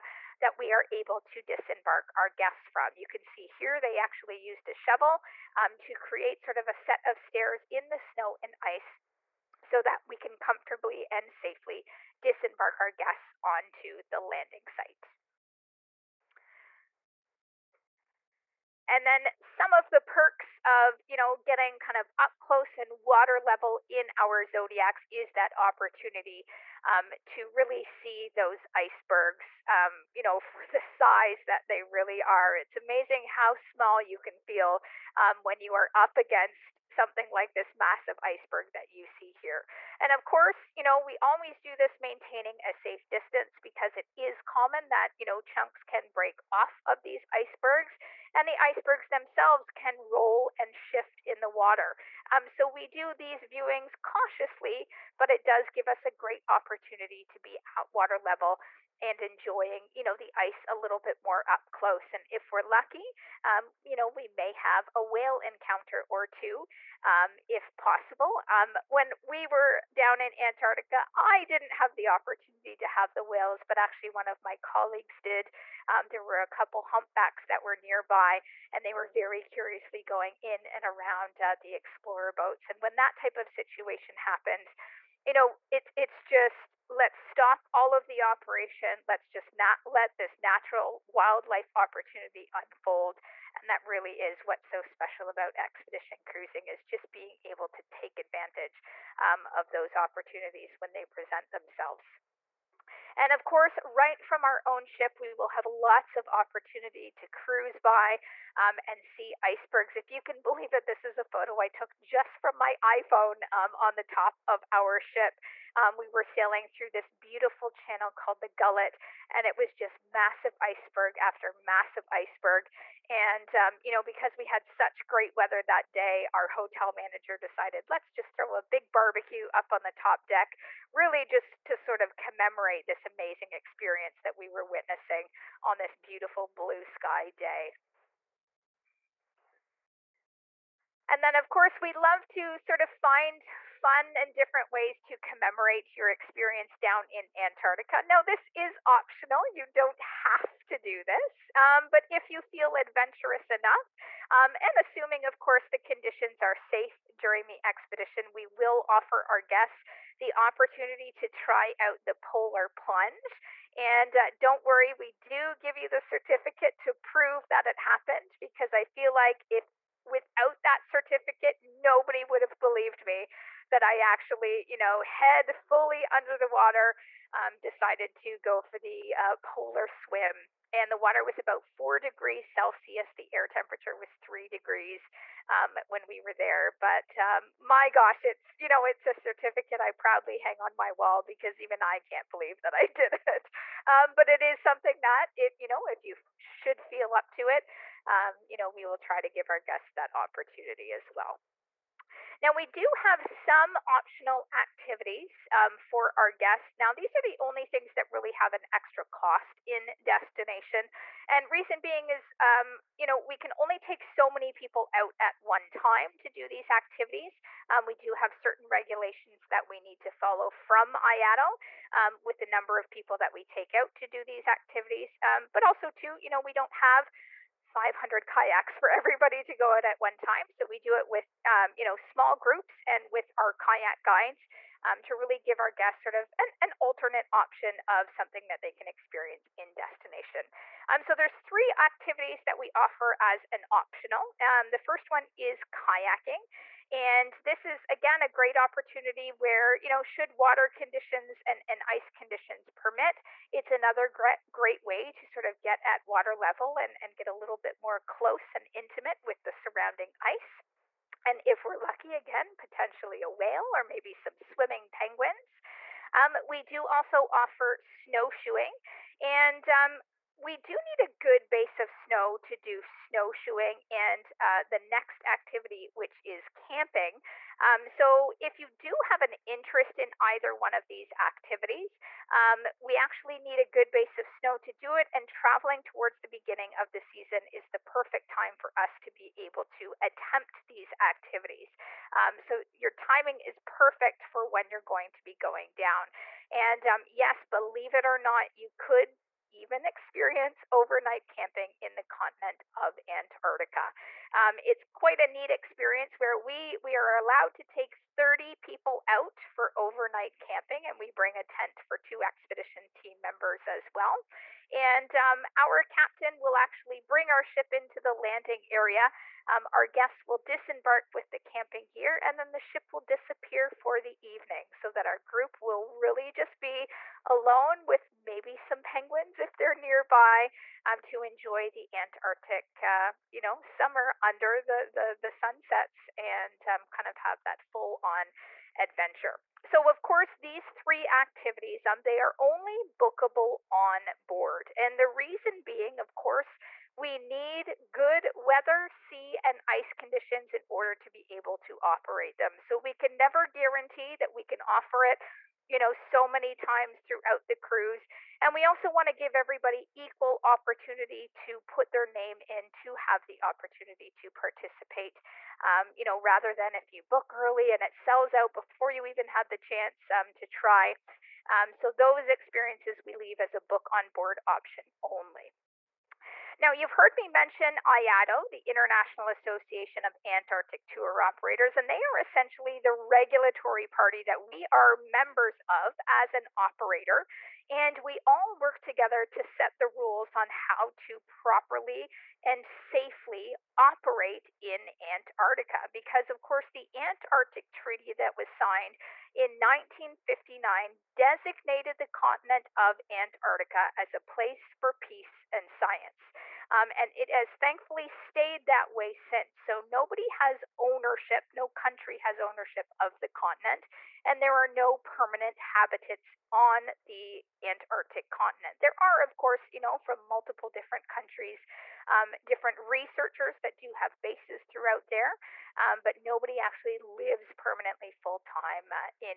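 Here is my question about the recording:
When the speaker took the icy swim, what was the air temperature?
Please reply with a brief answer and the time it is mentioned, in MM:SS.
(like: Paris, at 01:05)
3 degrees, at 03:04.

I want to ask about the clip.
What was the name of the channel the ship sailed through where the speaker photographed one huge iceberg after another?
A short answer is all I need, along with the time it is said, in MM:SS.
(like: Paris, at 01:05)
The Gullet, at 01:58.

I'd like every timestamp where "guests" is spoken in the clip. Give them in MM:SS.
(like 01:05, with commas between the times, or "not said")
00:02, 00:12, 02:39, 03:19, 03:26, 03:55, 05:19.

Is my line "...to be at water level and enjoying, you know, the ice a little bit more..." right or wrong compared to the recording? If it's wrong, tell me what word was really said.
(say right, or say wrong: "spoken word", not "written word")
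right.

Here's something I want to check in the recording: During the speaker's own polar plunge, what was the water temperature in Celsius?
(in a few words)
4 degrees Celsius.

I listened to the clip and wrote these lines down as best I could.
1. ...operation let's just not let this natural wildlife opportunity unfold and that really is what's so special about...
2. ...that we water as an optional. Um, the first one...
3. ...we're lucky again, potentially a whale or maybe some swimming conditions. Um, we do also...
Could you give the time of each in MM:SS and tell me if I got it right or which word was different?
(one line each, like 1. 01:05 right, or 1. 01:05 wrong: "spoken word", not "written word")
1. 01:28 right
2. 04:02 wrong: "offer", not "water"
3. 04:21 wrong: "penguins", not "conditions".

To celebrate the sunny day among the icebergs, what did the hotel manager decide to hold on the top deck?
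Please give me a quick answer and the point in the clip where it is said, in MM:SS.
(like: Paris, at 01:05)
A big barbecue, at 02:08.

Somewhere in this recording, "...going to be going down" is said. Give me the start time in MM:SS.
04:54.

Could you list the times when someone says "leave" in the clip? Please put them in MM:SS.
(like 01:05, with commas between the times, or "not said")
06:13.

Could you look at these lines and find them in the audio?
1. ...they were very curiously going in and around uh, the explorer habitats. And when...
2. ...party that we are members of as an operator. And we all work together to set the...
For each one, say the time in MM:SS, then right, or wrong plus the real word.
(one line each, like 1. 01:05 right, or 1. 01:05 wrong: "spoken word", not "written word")
1. 01:18 wrong: "boats", not "habitats"
2. 06:23 right.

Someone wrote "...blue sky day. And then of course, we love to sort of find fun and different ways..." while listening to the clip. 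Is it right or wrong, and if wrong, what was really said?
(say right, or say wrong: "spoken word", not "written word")
right.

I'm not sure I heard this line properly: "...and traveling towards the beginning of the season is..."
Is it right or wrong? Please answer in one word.
right.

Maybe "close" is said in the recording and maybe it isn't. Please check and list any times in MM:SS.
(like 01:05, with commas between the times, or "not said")
00:22, 01:01, 04:18.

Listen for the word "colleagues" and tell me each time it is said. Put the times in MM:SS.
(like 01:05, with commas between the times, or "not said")
01:14.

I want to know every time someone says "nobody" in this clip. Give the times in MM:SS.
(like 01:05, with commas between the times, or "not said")
02:51, 06:49, 07:06.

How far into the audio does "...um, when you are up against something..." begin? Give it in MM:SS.
00:35.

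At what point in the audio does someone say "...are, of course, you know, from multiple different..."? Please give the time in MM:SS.
06:59.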